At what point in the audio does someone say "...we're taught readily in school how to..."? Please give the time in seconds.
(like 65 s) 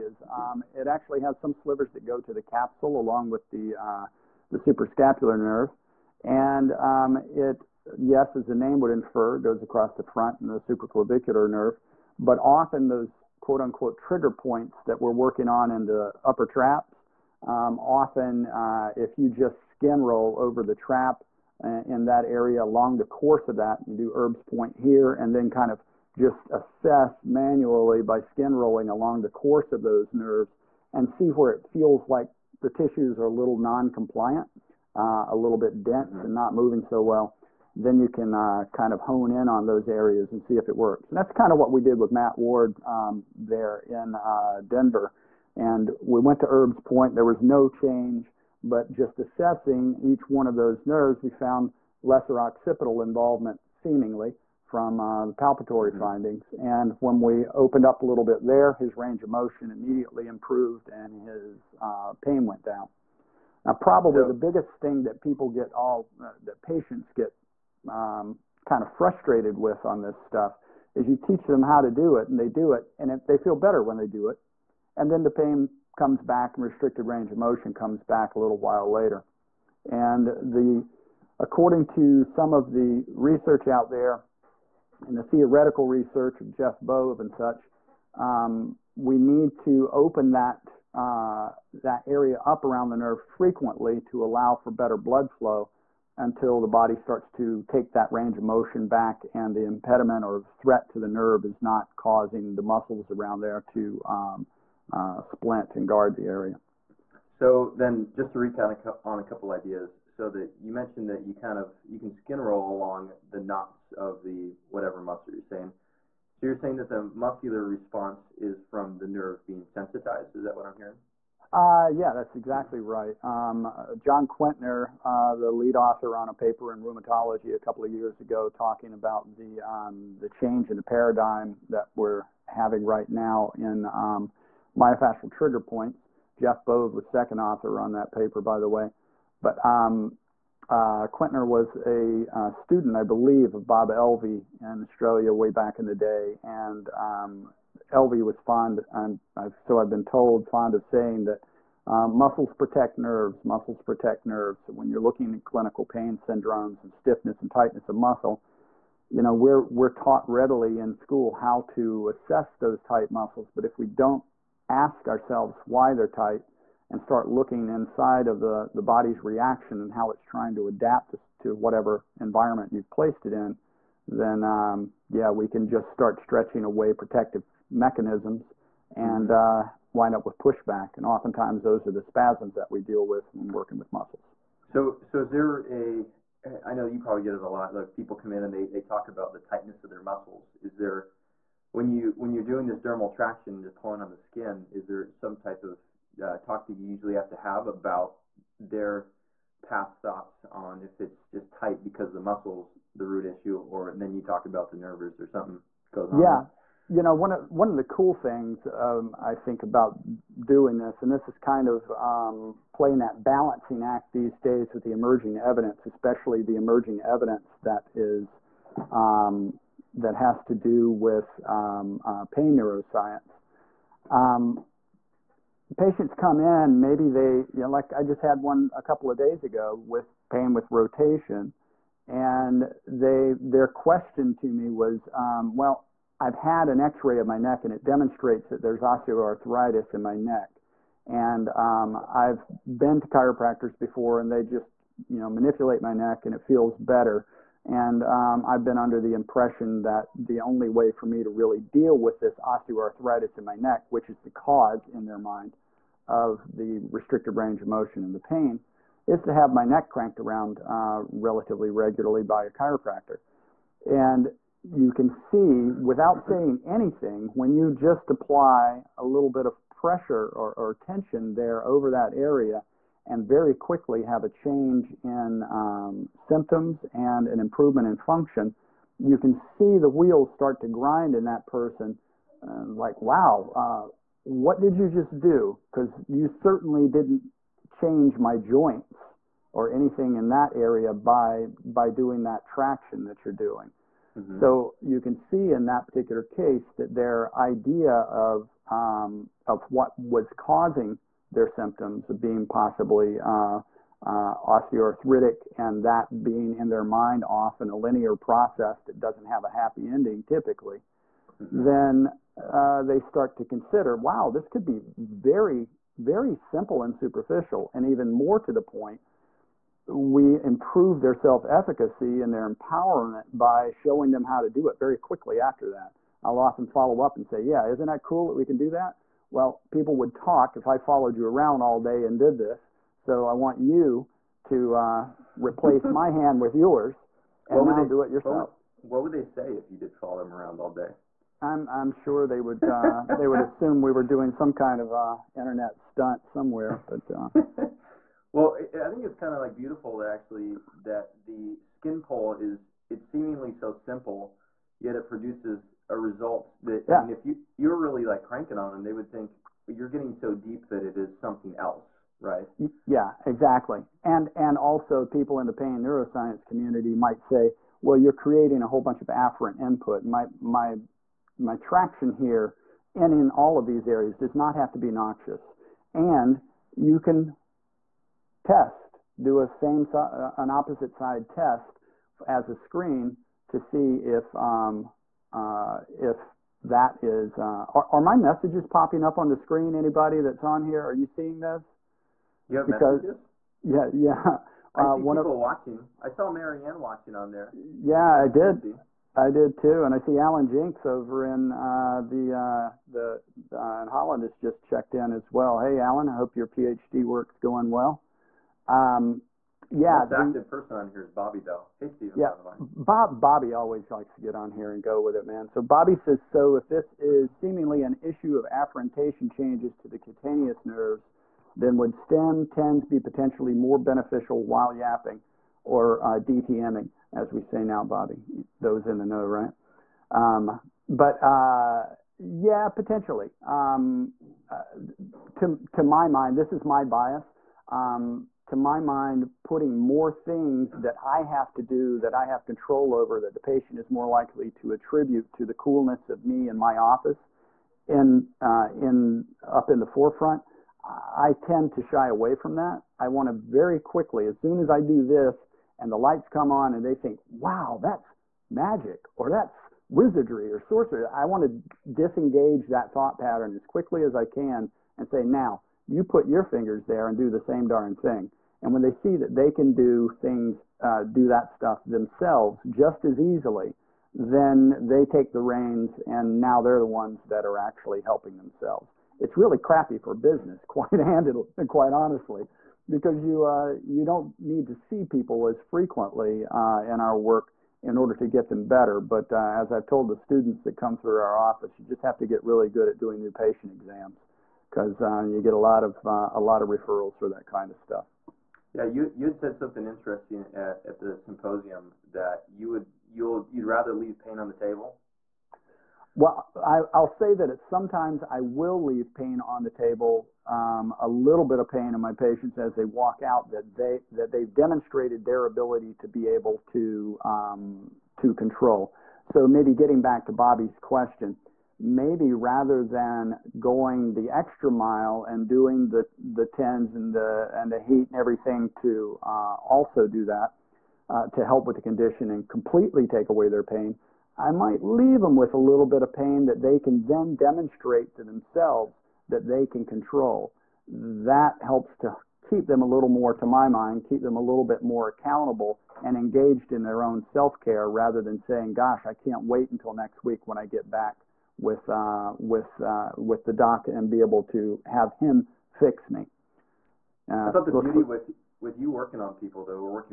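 159 s.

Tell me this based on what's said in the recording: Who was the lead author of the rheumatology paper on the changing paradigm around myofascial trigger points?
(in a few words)
John Quintner.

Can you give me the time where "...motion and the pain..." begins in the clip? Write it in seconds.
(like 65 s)
257 s.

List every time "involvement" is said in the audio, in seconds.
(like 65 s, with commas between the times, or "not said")
53 s.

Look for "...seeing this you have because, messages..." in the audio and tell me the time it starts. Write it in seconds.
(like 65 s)
391 s.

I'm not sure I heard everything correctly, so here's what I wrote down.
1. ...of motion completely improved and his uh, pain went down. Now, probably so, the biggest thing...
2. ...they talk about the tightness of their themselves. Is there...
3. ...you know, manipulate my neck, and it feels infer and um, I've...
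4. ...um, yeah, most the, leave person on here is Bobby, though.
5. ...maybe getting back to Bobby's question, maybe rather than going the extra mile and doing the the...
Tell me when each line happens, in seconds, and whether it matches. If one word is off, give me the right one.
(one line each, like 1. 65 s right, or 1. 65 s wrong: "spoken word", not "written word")
1. 59 s wrong: "immediately", not "completely"
2. 188 s wrong: "muscles", not "themselves"
3. 245 s wrong: "better", not "infer"
4. 408 s wrong: "active", not "leave"
5. 519 s right.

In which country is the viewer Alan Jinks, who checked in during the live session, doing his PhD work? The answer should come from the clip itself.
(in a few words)
Holland.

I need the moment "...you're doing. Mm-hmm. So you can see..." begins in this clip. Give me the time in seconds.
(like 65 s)
293 s.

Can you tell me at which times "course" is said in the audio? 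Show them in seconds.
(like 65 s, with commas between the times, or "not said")
23 s, 29 s.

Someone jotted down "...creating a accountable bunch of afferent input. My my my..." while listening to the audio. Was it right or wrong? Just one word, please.
wrong.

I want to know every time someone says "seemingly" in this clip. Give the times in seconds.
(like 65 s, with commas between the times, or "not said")
53 s, 353 s, 417 s.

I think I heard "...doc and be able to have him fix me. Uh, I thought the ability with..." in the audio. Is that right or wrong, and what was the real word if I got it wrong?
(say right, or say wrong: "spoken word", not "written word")
wrong: "beauty", not "ability".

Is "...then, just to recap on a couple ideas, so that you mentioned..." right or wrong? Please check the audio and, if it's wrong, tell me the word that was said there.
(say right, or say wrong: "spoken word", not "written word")
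right.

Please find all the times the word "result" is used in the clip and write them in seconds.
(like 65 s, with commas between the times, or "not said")
355 s.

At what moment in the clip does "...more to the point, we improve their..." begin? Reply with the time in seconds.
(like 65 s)
318 s.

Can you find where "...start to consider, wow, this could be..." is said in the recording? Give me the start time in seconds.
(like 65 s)
312 s.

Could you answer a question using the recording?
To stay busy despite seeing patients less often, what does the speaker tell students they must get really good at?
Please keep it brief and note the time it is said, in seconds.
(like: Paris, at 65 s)
new patient exams, at 493 s.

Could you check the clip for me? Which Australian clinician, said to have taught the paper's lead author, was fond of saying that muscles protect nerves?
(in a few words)
Bob Elvey.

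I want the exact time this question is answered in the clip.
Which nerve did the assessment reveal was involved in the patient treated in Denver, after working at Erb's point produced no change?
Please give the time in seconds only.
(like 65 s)
52 s.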